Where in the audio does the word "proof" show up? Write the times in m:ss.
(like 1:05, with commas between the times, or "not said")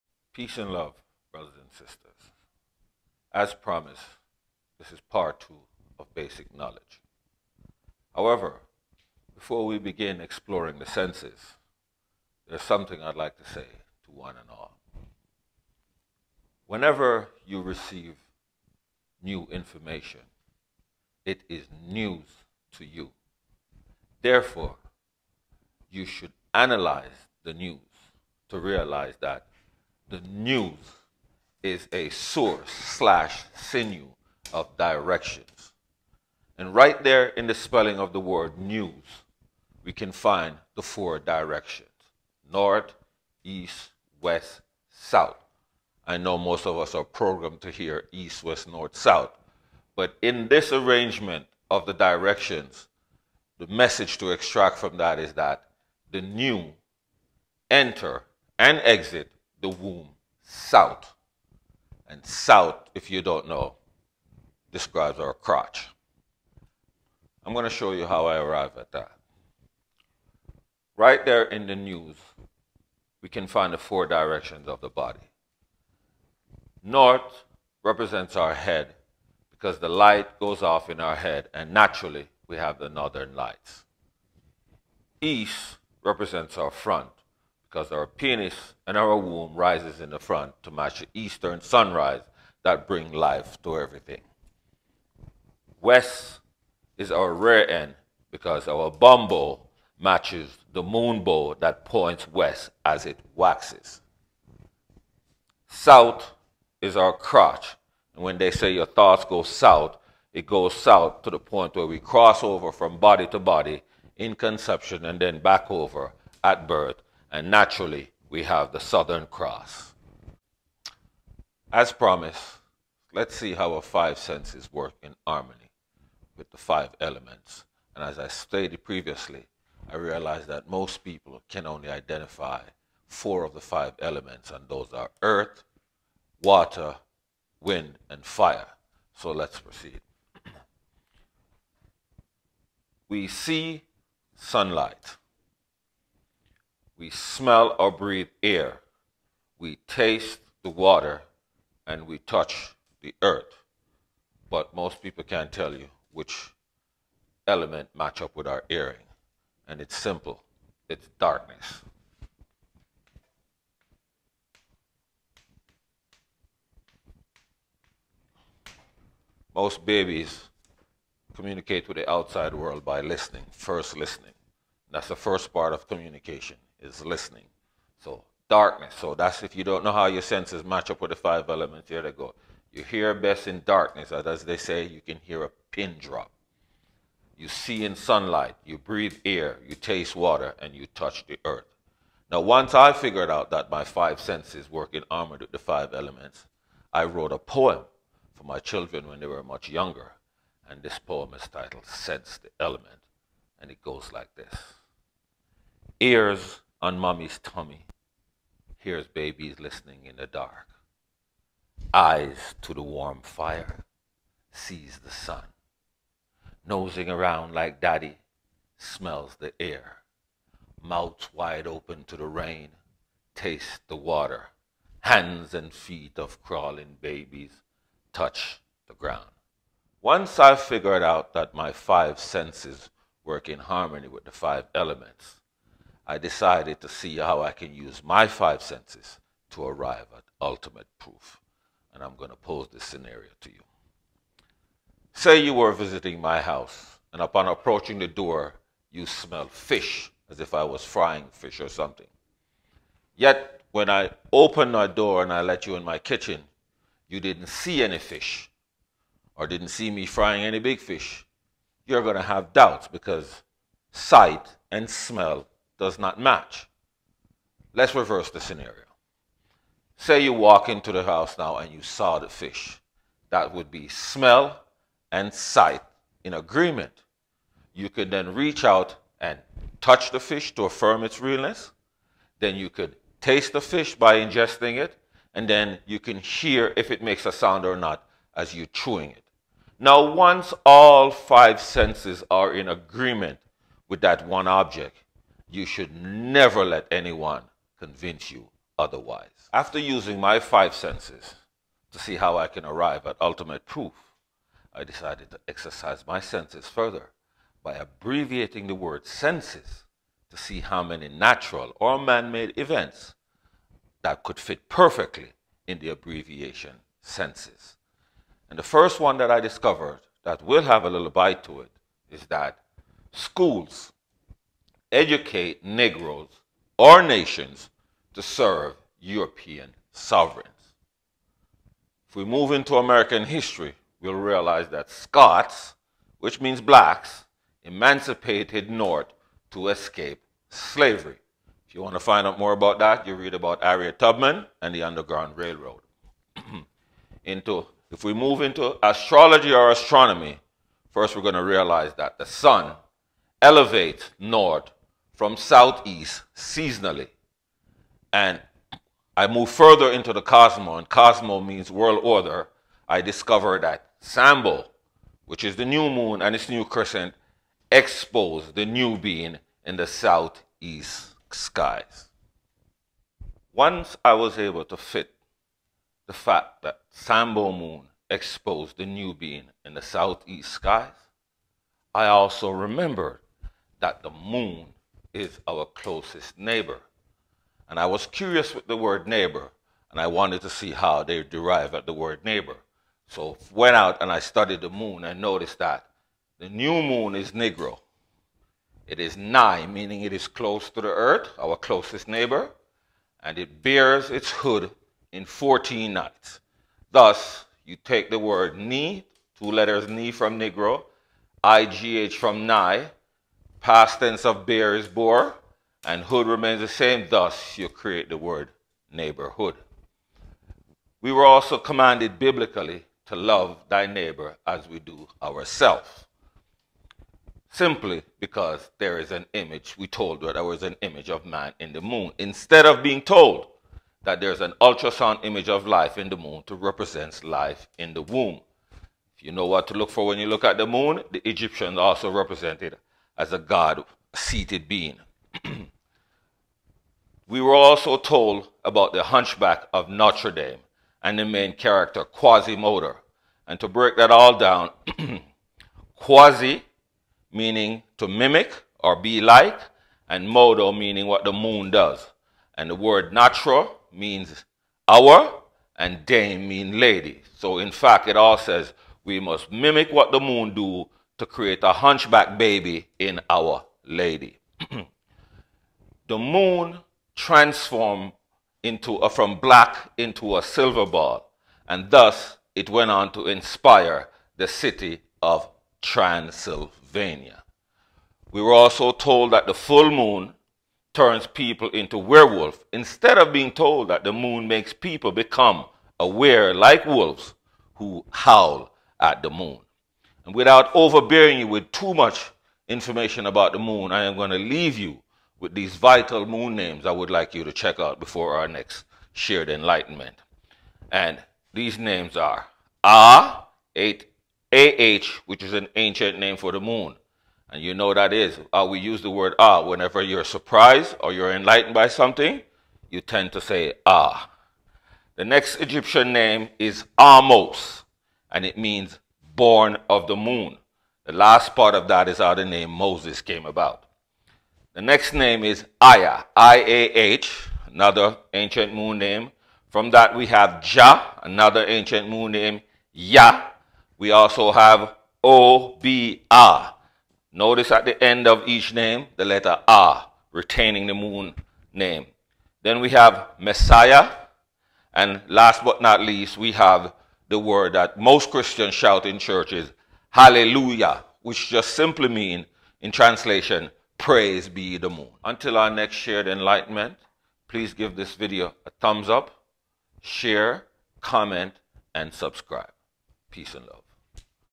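4:00, 5:03.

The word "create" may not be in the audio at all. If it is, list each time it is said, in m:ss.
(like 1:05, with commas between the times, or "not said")
6:57, 7:51.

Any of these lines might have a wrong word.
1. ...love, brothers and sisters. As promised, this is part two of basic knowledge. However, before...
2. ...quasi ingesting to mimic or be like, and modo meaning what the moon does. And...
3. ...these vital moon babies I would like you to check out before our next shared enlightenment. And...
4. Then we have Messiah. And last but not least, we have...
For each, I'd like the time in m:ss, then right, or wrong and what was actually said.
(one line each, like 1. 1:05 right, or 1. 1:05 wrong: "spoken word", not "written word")
1. 0:00 right
2. 7:35 wrong: "meaning", not "ingesting"
3. 8:25 wrong: "names", not "babies"
4. 9:12 right.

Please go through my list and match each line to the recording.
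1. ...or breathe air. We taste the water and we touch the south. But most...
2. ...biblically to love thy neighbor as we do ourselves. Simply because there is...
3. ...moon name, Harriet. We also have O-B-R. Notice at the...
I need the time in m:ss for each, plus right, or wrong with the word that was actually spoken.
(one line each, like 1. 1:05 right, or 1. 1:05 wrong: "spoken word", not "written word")
1. 2:27 wrong: "earth", not "south"
2. 7:02 right
3. 9:02 wrong: "Yah", not "Harriet".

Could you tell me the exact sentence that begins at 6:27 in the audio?
And I was curious with the word neighbor, and I wanted to see how they derive at the word neighbor.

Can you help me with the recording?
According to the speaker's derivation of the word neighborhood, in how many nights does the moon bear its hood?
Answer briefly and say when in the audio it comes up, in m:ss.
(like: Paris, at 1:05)
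14, at 6:45.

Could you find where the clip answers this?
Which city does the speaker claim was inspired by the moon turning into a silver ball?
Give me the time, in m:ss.
8:05.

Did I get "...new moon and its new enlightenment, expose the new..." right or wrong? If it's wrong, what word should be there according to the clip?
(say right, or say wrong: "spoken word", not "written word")
wrong: "crescent", not "enlightenment".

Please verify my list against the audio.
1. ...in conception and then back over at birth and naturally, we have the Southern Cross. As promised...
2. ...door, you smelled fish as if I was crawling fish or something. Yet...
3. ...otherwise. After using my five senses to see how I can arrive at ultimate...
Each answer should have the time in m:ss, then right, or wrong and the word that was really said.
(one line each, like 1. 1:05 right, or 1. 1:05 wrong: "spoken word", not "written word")
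1. 1:54 right
2. 4:08 wrong: "frying", not "crawling"
3. 4:58 right.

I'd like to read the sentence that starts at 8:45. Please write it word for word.
The next Egyptian name is Ahmose, and it means born of the moon.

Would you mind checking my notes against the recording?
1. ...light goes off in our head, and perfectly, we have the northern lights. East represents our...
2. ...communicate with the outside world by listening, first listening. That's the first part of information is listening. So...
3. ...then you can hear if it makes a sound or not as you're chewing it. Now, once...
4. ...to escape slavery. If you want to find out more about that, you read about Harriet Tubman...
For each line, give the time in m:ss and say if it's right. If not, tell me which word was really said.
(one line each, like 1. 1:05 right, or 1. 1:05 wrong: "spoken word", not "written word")
1. 1:19 wrong: "naturally", not "perfectly"
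2. 2:51 wrong: "communication", not "information"
3. 4:45 right
4. 5:39 right.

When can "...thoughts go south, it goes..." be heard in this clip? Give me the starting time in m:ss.
1:48.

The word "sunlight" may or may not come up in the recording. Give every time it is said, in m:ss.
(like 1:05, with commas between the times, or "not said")
2:24, 3:07.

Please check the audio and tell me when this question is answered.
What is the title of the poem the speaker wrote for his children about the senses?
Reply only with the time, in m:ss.
3:21.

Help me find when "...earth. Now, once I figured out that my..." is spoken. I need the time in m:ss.
3:11.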